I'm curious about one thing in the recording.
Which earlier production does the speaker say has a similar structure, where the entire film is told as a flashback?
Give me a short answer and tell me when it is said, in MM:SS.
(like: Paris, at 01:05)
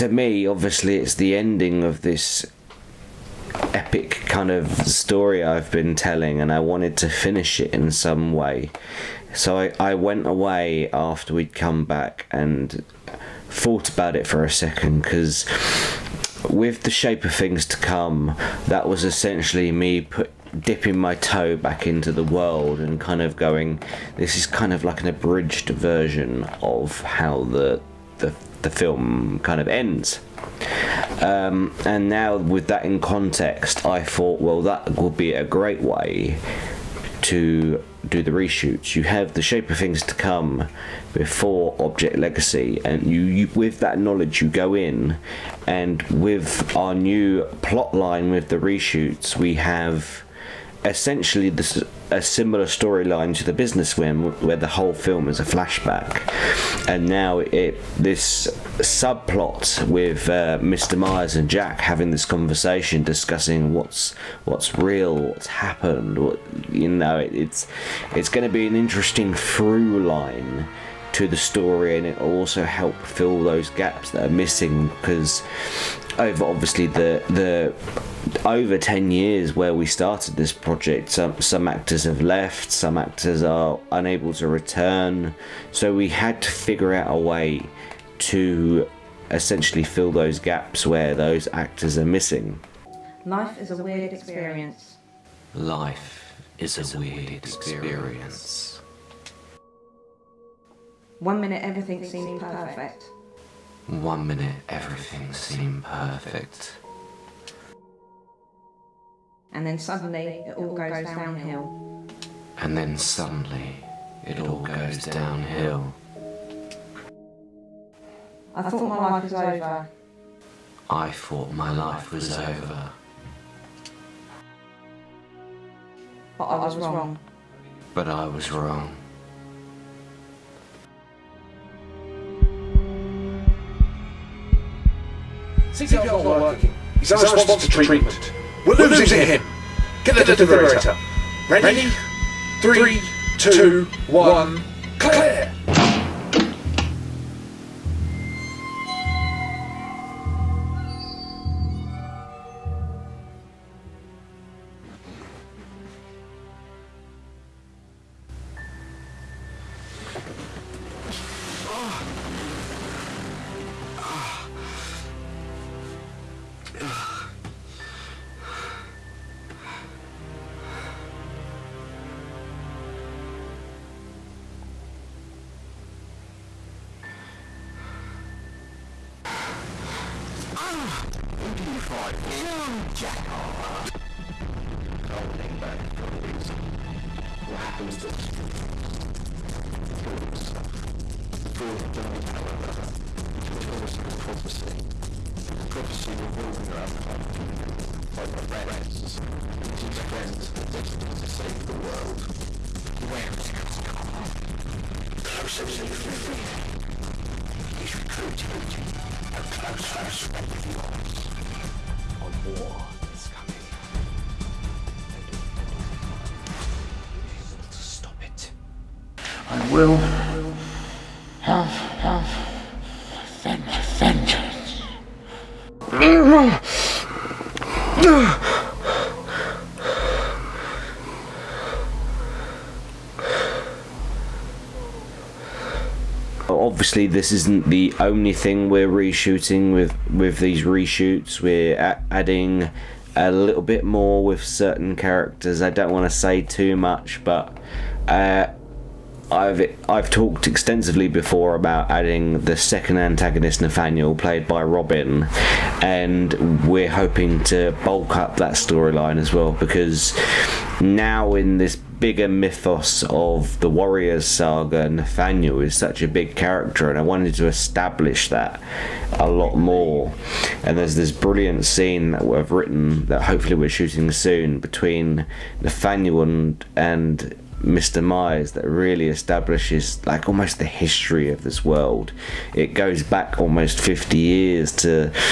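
The Businessman, at 00:53.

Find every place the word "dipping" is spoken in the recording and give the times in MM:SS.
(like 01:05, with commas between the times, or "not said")
00:20.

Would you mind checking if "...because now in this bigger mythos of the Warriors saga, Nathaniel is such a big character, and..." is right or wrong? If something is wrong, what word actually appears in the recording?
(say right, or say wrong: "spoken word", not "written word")
right.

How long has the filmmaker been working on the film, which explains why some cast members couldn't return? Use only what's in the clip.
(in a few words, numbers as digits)
over 10 years.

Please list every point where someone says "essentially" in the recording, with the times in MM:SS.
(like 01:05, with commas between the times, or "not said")
00:19, 00:50, 01:29.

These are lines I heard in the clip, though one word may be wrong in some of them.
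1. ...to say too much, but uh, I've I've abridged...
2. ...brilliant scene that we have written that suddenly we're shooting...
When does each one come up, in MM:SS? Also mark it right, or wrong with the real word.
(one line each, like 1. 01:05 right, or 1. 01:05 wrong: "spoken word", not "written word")
1. 04:06 wrong: "talked", not "abridged"
2. 04:31 wrong: "hopefully", not "suddenly".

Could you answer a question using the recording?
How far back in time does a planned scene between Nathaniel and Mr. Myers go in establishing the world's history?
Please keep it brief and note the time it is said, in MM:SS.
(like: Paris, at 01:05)
almost 50 years, at 04:43.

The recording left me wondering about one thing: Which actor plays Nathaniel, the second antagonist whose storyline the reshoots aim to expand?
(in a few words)
Robin.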